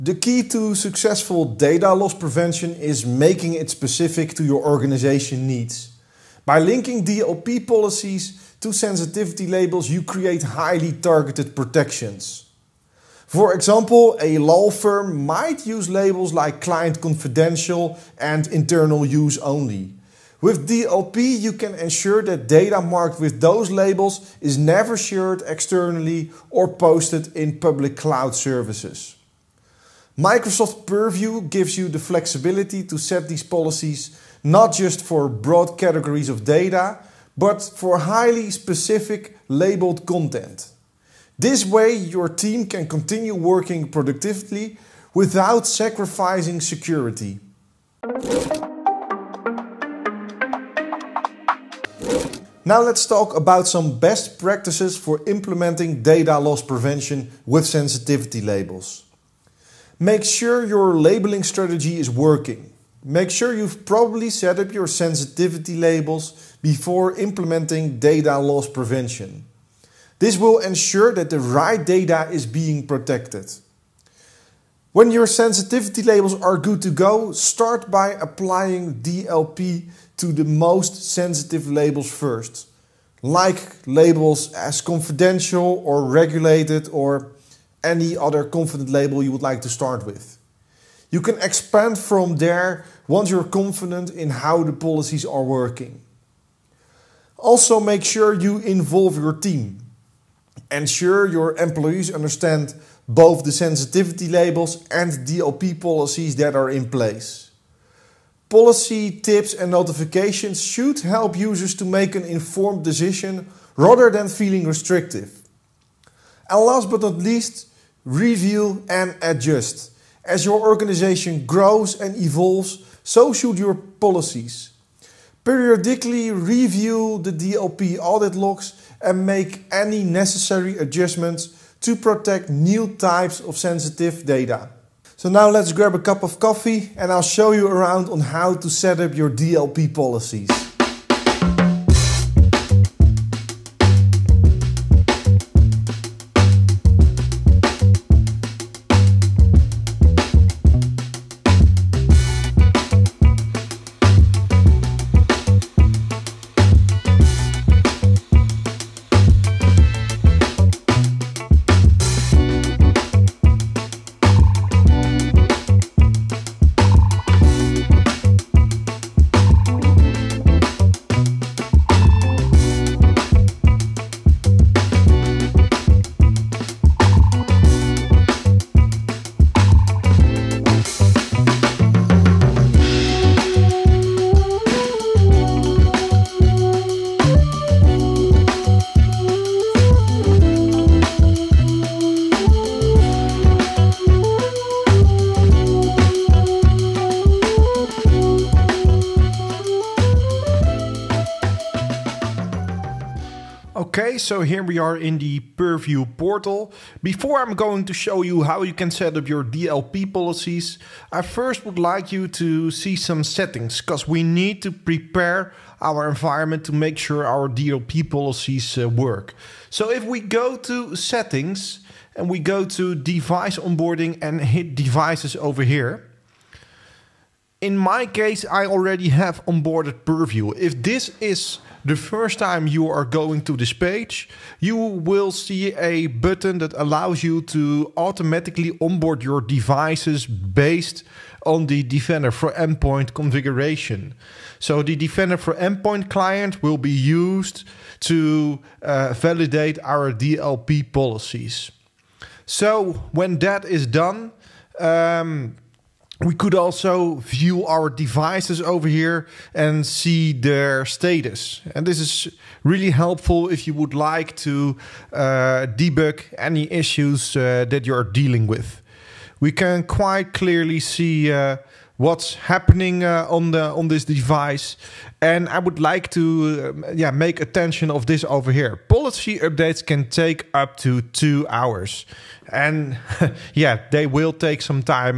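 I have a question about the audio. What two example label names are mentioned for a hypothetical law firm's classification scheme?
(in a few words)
client confidential and internal use only.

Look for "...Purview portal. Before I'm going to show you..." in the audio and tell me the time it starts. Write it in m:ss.
3:25.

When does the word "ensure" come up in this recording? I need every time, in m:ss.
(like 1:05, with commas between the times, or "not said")
0:21, 1:10, 1:40.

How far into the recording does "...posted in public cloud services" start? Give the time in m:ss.
0:26.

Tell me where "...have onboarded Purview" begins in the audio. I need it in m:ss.
3:49.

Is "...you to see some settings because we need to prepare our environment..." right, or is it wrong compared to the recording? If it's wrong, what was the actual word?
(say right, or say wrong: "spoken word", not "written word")
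right.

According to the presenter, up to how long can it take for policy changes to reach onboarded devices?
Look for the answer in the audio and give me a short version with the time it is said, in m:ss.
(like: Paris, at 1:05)
2 hours, at 4:41.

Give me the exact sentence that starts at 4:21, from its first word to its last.
And this is really helpful if you would like to uh, debug any issues uh, that you're dealing with.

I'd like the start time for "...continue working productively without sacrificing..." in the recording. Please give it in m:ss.
0:42.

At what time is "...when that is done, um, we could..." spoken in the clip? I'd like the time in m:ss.
4:13.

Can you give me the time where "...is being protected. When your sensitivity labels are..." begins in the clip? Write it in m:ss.
1:12.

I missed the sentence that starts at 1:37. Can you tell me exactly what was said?
Also, make sure you involve your team.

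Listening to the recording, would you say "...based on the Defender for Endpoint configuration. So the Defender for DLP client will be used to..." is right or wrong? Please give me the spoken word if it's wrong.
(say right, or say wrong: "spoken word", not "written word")
wrong: "Endpoint", not "DLP".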